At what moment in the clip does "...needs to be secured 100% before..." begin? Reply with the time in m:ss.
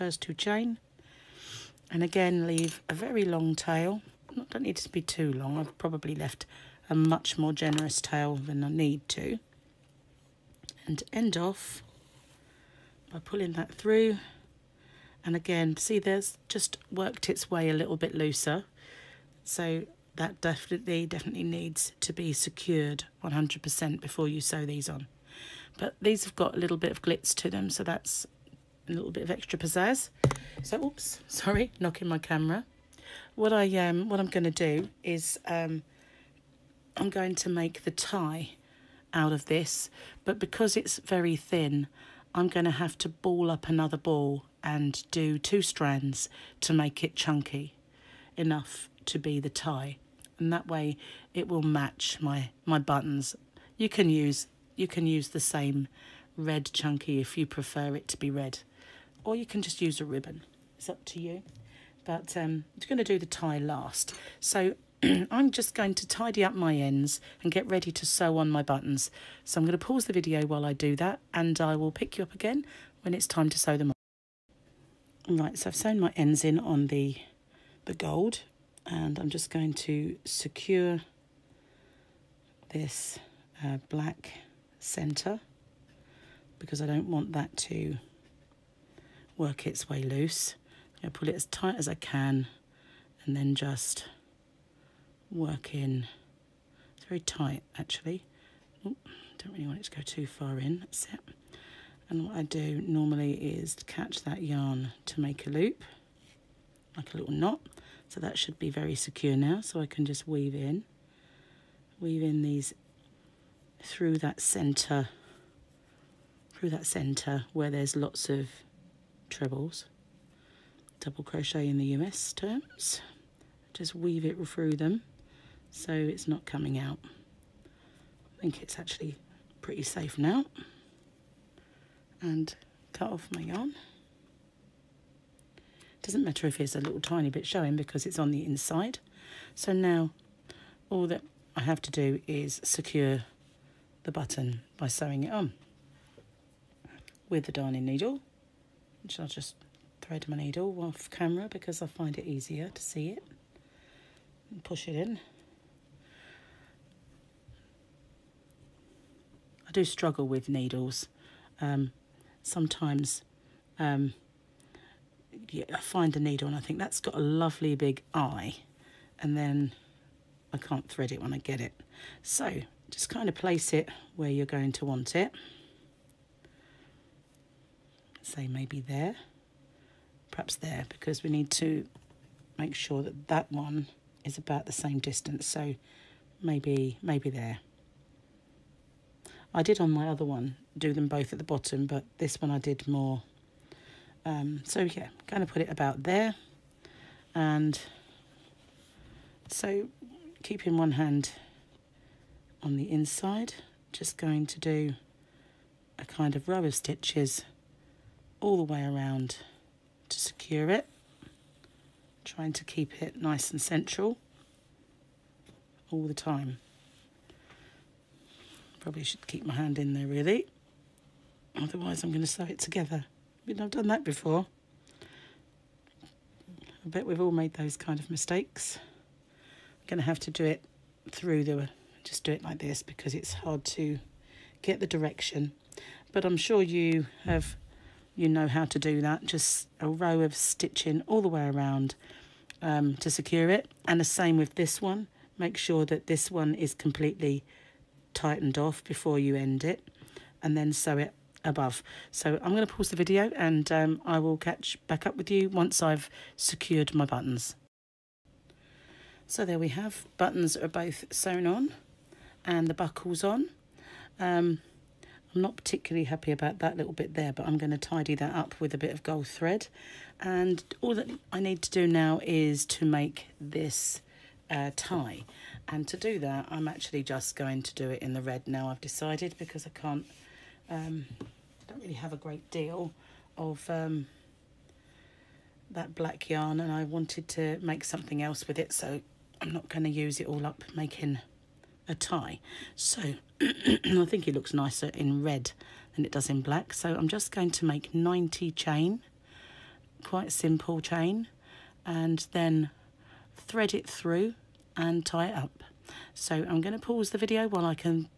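0:21.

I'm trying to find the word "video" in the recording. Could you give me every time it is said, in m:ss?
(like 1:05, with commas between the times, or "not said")
1:10, 4:12, 5:07.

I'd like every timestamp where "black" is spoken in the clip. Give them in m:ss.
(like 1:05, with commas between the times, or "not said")
1:23, 4:45, 4:56.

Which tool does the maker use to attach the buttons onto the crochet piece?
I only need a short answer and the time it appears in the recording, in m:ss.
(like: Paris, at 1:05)
darning needle, at 2:27.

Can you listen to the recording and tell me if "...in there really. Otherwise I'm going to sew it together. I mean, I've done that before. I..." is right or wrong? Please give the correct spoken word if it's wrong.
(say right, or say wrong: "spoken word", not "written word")
right.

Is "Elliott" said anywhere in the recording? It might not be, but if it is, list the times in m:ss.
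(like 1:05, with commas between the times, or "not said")
not said.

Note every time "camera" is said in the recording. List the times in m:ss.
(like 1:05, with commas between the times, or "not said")
0:32, 2:31.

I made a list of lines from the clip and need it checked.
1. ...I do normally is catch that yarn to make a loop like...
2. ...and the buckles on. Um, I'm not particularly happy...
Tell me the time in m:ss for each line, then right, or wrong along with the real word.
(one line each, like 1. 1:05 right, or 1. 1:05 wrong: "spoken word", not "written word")
1. 1:42 right
2. 4:22 right.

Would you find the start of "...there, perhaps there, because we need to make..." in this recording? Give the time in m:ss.
2:58.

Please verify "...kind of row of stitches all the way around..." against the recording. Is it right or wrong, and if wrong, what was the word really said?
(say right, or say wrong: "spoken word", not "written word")
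right.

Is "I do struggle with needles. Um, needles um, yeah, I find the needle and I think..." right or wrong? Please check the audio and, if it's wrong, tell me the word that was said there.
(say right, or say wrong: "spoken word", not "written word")
wrong: "sometimes", not "needles".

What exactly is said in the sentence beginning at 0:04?
don't need it to be too long.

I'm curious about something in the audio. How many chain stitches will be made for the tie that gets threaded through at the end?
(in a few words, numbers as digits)
90.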